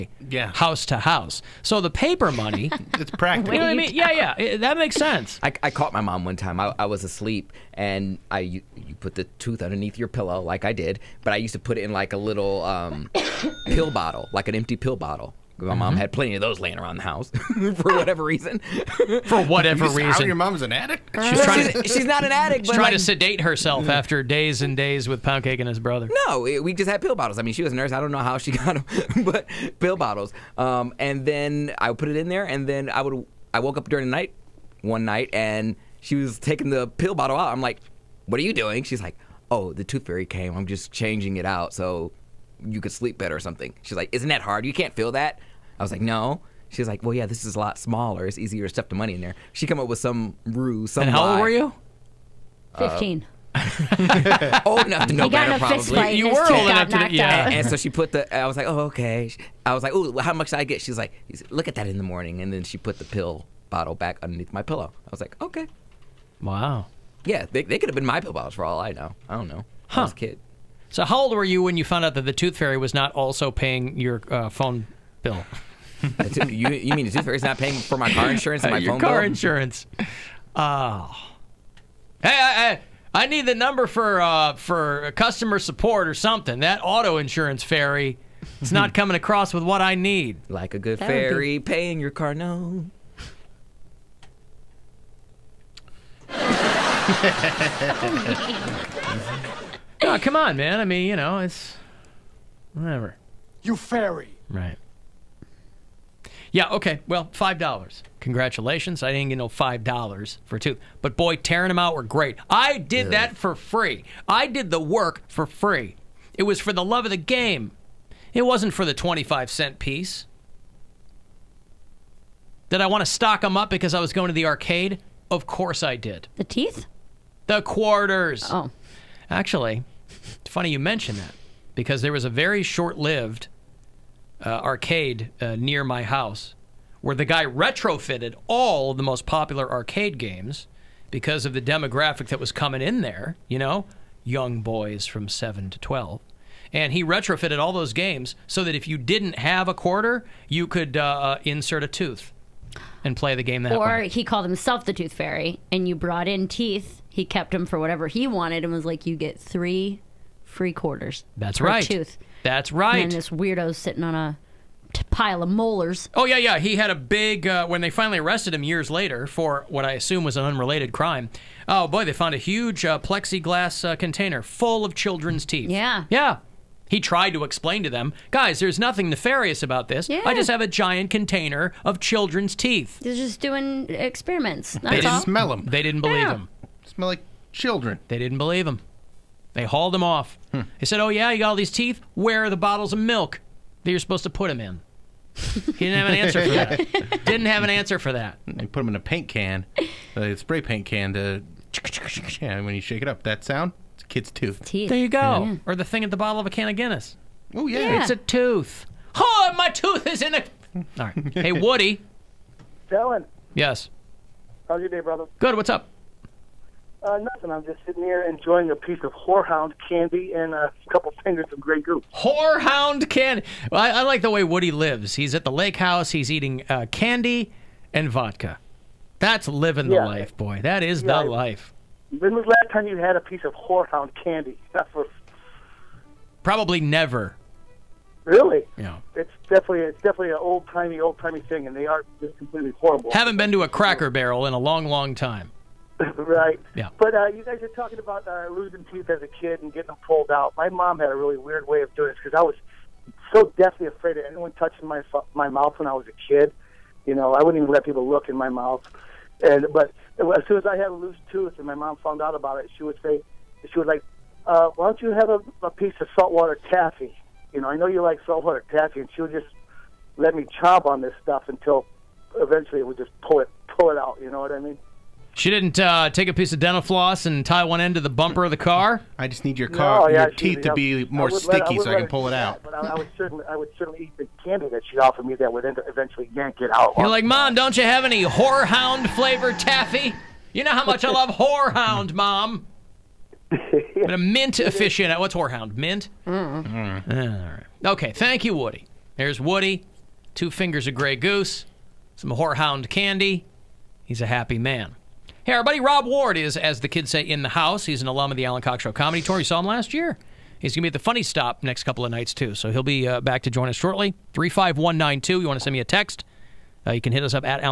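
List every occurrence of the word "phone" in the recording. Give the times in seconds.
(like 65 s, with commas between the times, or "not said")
74 s, 78 s.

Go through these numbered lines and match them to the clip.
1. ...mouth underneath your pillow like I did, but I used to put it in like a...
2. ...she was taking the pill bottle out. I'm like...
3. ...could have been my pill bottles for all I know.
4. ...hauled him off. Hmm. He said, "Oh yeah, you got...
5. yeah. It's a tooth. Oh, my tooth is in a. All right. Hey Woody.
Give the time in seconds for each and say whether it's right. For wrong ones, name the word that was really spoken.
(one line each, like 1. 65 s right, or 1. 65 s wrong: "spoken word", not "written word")
1. 9 s wrong: "tooth", not "mouth"
2. 35 s right
3. 67 s right
4. 189 s right
5. 207 s right.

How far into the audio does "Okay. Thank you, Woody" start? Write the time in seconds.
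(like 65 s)
297 s.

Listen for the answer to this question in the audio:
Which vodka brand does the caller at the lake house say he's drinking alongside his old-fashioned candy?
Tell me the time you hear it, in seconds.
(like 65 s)
221 s.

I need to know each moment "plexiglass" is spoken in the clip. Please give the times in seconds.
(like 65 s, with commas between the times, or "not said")
172 s.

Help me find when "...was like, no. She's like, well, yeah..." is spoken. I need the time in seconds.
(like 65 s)
45 s.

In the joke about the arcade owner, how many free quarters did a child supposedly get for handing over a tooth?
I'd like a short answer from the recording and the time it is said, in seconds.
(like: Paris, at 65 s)
3, at 159 s.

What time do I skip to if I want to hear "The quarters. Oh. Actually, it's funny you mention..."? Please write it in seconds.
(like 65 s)
127 s.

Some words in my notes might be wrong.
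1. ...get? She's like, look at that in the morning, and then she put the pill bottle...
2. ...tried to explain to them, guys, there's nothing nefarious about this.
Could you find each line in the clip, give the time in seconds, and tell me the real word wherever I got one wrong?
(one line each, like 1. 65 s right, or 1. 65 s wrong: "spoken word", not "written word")
1. 60 s right
2. 176 s right.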